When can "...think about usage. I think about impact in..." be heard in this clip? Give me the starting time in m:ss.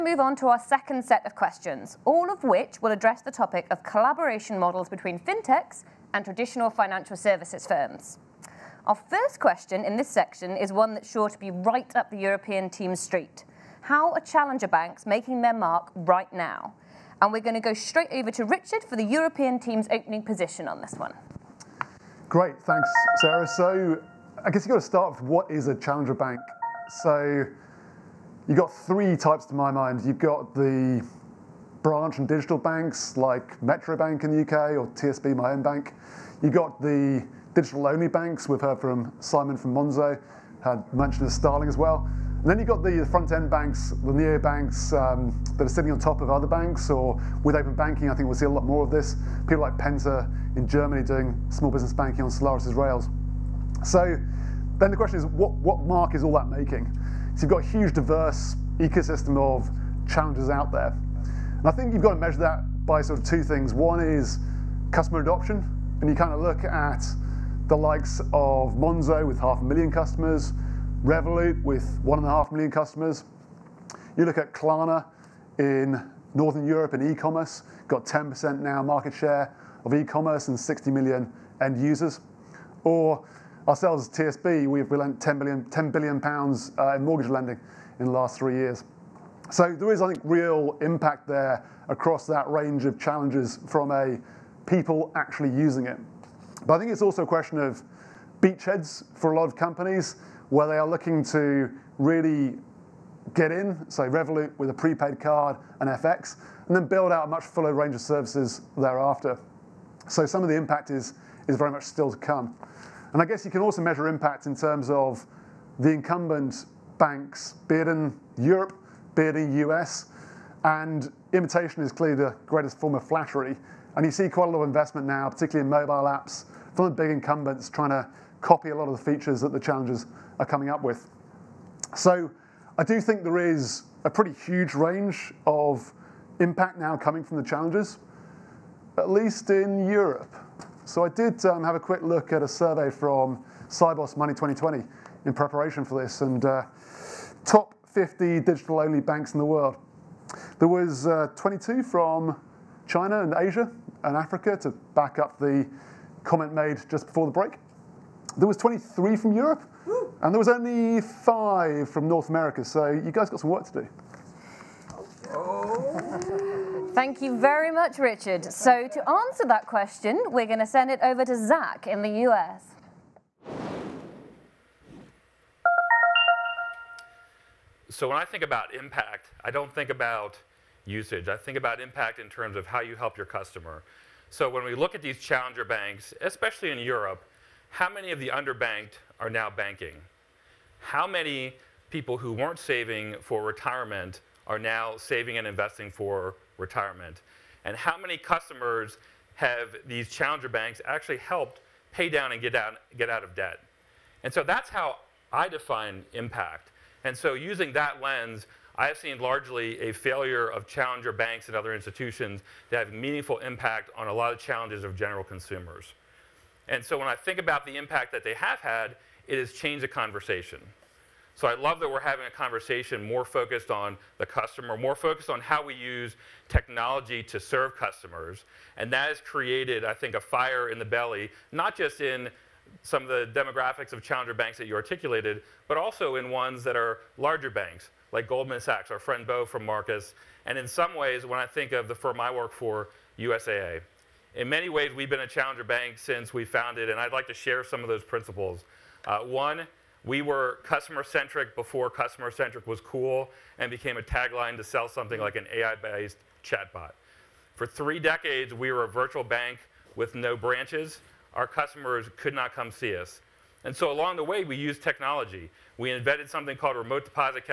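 2:59.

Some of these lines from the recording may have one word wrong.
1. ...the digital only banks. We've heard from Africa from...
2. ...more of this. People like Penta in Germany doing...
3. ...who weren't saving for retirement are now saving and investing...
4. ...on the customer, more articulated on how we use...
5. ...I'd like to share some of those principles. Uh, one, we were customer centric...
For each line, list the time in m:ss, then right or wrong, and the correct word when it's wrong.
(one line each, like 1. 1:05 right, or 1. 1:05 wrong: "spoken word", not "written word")
1. 0:36 wrong: "Simon", not "Africa"
2. 0:48 right
3. 3:12 right
4. 3:43 wrong: "focused", not "articulated"
5. 4:06 right.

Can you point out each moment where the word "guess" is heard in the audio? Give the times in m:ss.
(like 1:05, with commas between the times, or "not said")
0:24, 1:53.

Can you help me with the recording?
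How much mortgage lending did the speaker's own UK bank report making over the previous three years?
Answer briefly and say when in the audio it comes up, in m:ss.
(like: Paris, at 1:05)
10 billion pounds, at 1:25.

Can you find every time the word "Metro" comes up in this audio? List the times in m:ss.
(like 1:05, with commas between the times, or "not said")
0:33.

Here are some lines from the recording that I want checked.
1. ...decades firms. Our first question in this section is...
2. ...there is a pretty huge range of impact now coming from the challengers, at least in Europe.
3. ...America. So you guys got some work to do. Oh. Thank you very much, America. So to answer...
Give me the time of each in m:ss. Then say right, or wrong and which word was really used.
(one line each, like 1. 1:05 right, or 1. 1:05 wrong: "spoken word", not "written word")
1. 0:07 wrong: "services", not "decades"
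2. 2:13 right
3. 2:42 wrong: "Richard", not "America".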